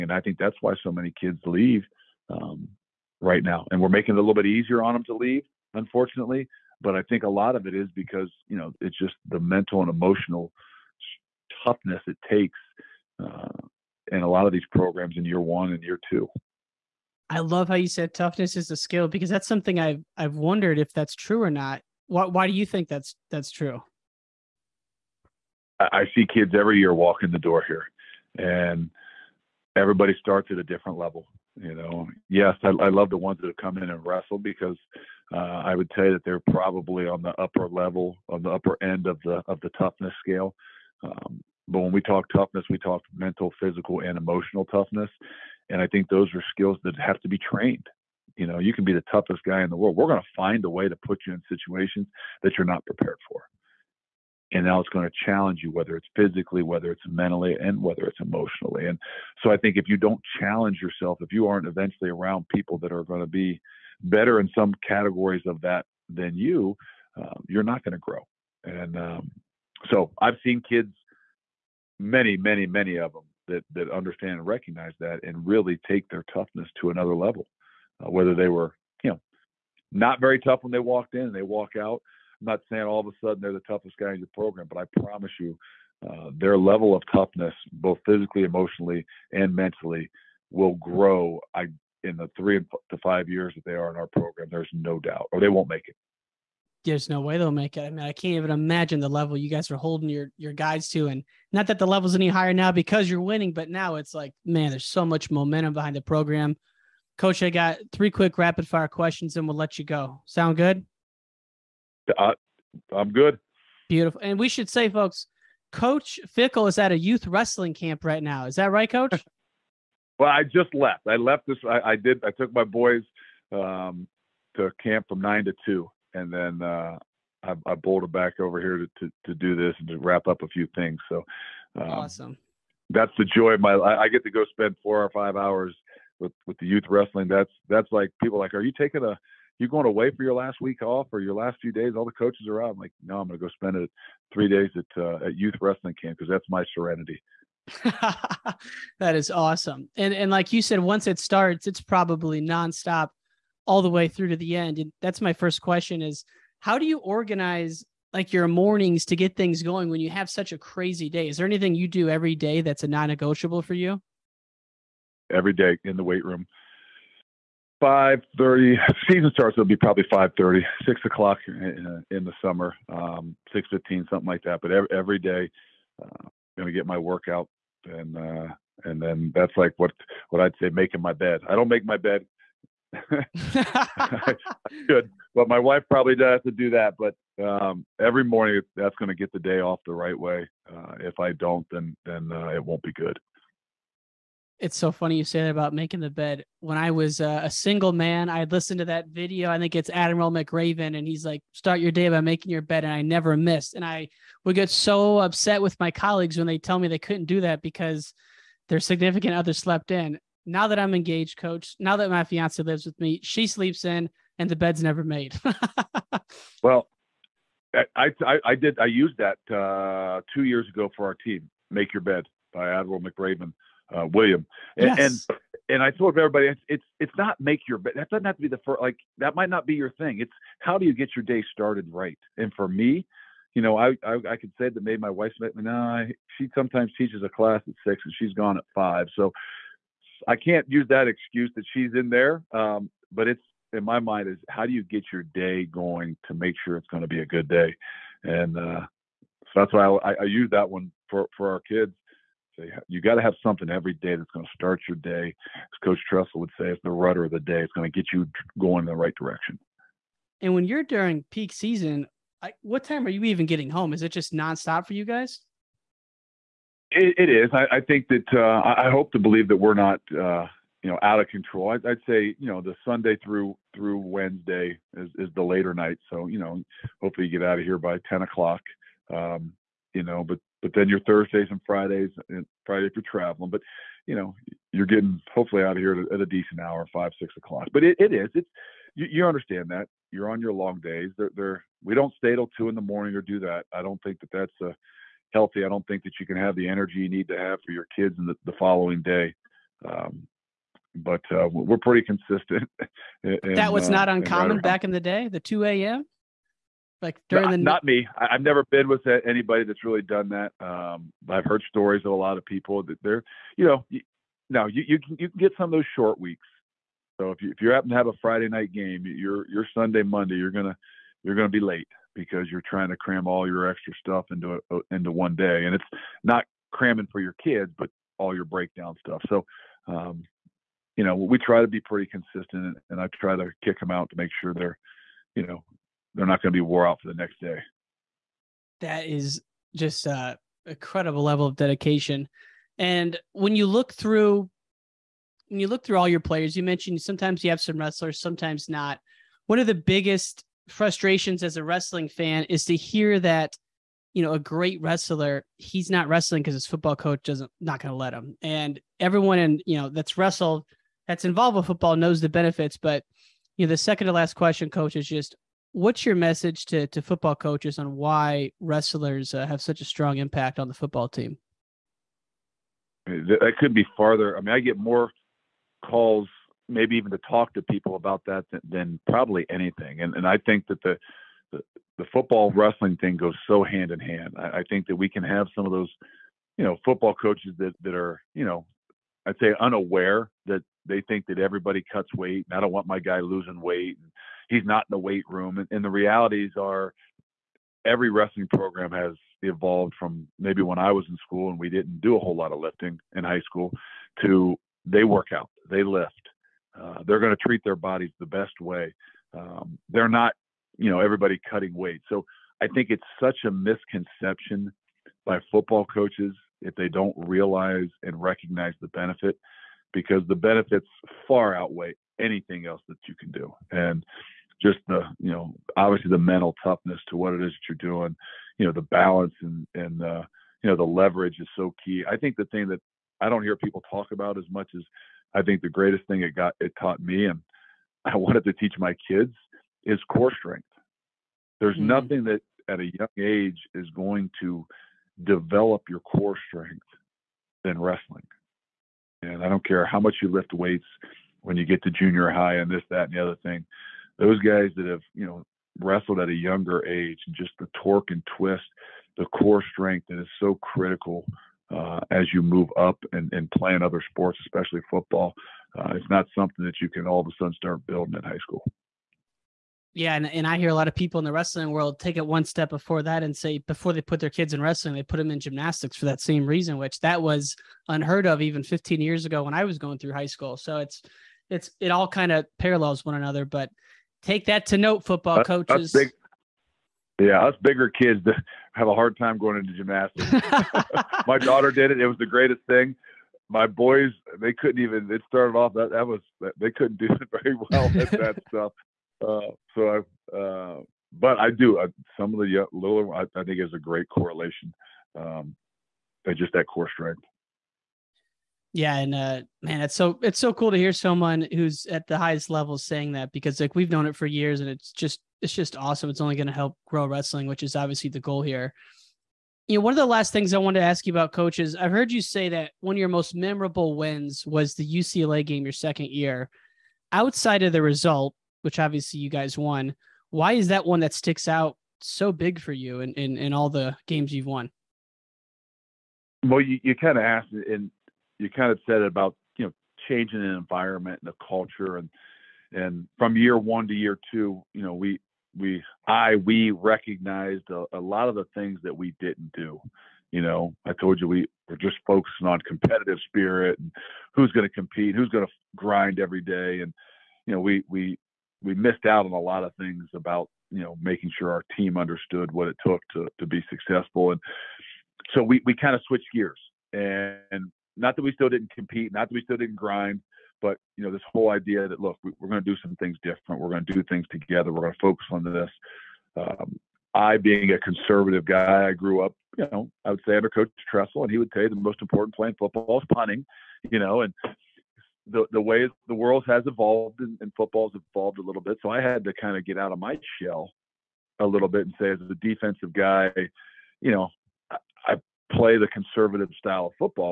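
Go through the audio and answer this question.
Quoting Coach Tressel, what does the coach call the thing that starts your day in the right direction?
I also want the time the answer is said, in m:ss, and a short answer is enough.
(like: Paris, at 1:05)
the rudder of the day, at 4:16.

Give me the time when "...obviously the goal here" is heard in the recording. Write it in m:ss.
8:37.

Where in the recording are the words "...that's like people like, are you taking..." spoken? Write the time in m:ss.
2:17.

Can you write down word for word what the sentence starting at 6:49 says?
Um, they're not, you know, everybody cutting weight.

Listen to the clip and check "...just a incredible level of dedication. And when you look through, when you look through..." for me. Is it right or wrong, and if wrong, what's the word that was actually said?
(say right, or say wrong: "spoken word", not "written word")
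right.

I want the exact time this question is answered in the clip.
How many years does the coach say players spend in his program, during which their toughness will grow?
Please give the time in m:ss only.
1:32.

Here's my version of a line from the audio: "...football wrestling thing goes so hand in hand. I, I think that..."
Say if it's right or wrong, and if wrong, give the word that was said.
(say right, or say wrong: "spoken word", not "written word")
right.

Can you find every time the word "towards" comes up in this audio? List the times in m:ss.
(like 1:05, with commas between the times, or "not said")
not said.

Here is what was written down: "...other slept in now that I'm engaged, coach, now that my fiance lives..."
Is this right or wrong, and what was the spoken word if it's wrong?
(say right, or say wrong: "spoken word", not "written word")
right.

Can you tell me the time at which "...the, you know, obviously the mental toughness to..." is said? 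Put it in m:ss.
7:04.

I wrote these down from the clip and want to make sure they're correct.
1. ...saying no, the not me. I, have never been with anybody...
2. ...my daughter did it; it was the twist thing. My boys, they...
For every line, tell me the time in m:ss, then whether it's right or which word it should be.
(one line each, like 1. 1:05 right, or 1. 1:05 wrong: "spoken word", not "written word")
1. 5:07 wrong: "during", not "saying"
2. 8:11 wrong: "greatest", not "twist".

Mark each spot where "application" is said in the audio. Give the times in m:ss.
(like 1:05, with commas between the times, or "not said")
not said.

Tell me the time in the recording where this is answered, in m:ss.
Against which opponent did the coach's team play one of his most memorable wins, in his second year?
8:44.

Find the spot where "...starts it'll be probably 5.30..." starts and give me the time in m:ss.
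2:49.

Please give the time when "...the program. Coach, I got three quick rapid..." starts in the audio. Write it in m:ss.
1:45.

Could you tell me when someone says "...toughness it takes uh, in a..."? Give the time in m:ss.
0:11.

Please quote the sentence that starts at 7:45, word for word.
Uh, it's not something that you can all of a sudden start building in high school.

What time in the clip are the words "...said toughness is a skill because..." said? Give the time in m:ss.
0:17.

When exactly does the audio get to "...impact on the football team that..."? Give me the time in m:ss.
6:10.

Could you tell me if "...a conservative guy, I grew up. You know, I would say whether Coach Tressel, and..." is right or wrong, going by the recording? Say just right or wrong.
wrong.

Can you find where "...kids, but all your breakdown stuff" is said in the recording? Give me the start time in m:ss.
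5:27.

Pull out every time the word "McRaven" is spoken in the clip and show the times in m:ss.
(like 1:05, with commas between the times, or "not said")
3:20, 3:42.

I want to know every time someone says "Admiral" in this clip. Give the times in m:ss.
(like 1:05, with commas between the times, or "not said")
3:19, 3:42.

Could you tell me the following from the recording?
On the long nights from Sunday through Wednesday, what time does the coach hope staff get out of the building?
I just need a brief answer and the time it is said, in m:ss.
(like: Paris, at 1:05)
10 o'clock, at 4:38.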